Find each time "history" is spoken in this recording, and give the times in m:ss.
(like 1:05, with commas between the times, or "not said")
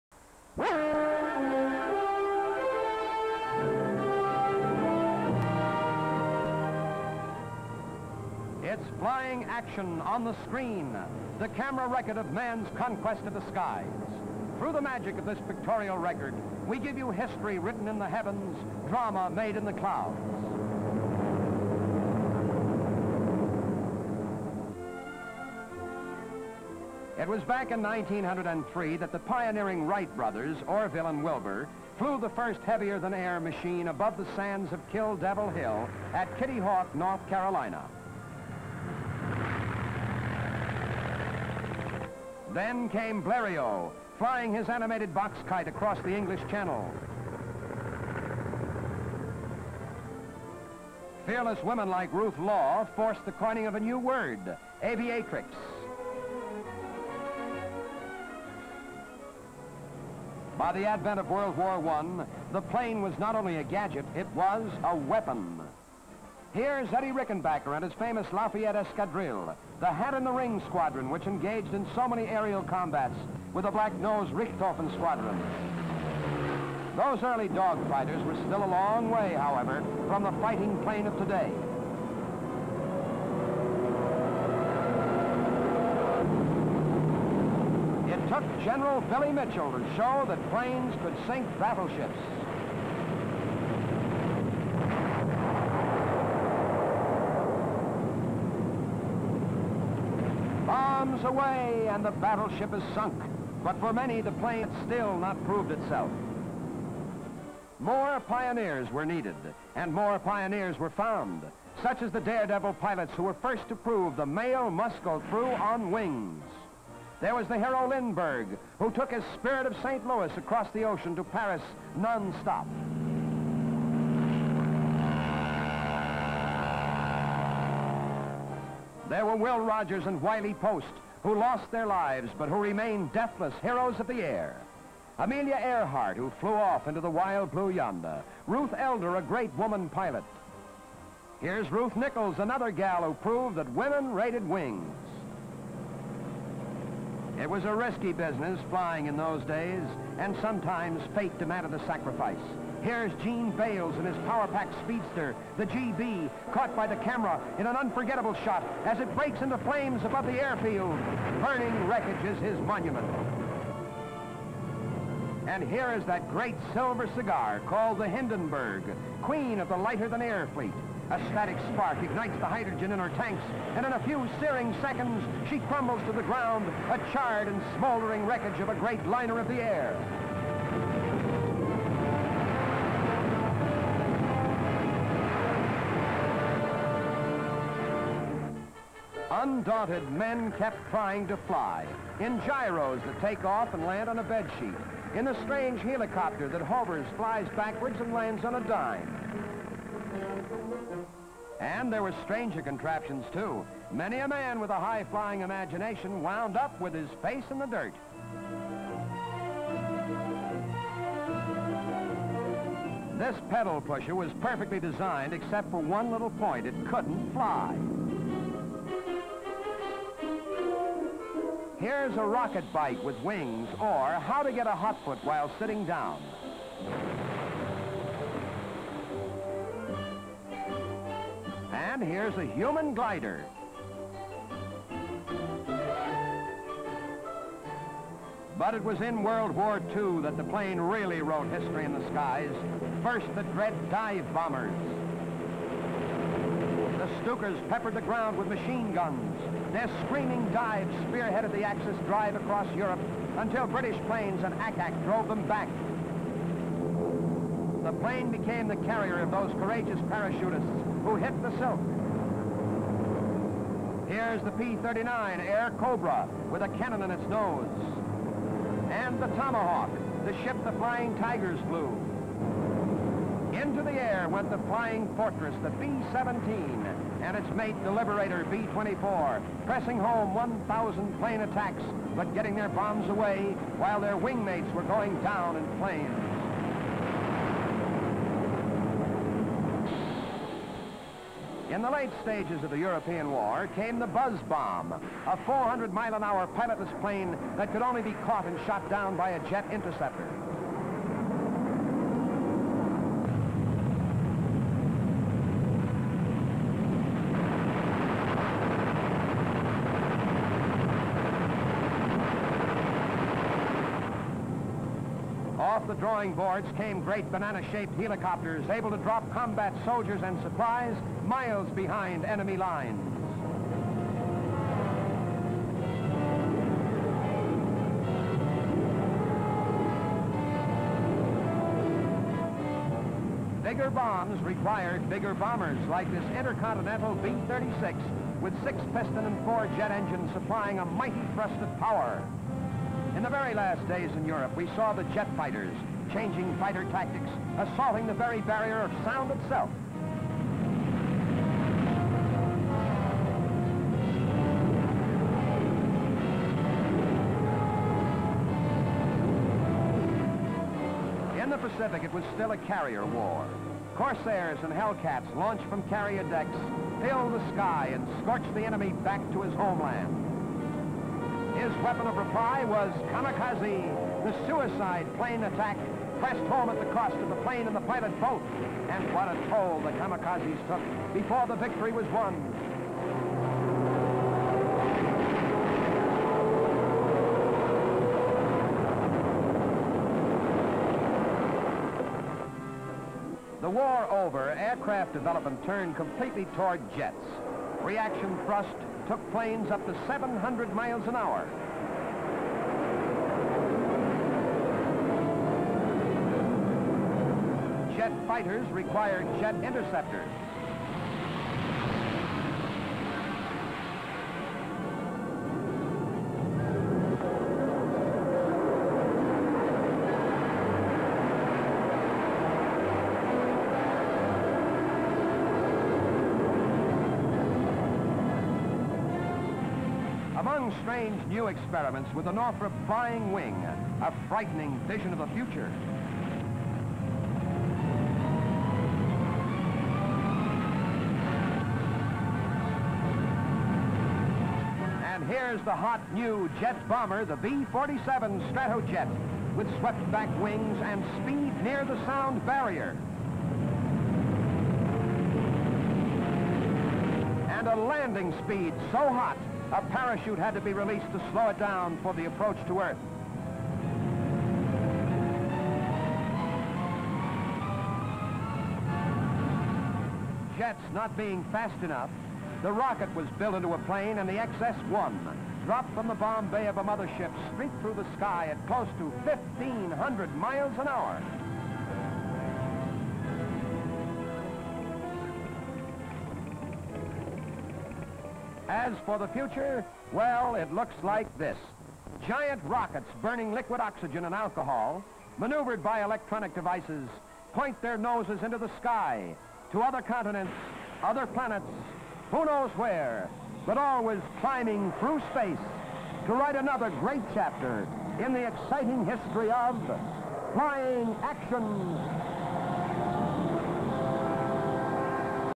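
0:17, 4:01, 8:29.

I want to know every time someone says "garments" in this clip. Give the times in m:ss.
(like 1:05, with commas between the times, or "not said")
not said.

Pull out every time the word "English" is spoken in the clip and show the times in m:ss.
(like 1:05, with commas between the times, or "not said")
0:46.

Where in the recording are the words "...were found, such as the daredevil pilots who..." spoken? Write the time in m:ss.
1:50.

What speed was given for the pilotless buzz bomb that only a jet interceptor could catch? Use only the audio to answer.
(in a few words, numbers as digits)
400 miles an hour.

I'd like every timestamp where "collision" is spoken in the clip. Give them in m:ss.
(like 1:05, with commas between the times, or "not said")
not said.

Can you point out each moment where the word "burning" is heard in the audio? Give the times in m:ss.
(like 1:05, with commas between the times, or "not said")
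2:41, 8:13.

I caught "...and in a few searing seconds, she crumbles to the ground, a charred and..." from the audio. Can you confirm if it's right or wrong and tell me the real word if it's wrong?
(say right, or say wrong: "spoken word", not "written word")
right.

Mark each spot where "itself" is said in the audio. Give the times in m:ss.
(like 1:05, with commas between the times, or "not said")
1:45, 5:49.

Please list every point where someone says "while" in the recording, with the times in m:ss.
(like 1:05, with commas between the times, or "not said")
3:45, 4:43.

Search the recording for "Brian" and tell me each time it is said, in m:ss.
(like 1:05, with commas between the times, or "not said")
not said.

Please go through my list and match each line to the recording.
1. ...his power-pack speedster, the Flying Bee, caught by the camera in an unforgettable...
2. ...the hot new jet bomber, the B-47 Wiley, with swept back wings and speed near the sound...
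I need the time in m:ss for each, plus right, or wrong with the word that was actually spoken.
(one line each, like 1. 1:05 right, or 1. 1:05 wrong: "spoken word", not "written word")
1. 2:34 wrong: "Gee", not "Flying"
2. 7:25 wrong: "Stratojet", not "Wiley".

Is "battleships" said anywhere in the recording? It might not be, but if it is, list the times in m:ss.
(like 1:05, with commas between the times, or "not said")
1:31, 1:42.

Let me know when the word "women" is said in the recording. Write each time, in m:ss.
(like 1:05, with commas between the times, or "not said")
0:51, 2:23.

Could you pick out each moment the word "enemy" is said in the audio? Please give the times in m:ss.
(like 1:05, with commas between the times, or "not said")
5:22, 6:08.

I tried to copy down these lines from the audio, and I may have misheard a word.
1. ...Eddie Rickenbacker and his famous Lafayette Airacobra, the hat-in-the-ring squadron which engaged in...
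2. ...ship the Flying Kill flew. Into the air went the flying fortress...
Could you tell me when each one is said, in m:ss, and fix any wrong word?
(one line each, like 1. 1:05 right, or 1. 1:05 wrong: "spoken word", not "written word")
1. 1:06 wrong: "Escadrille", not "Airacobra"
2. 4:30 wrong: "Tigers", not "Kill".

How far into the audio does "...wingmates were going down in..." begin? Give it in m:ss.
4:44.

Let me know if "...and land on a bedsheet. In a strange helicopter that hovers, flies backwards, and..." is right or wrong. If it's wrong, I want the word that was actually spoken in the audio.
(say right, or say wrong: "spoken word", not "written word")
right.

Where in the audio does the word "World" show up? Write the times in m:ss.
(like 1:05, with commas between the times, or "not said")
1:01, 3:59.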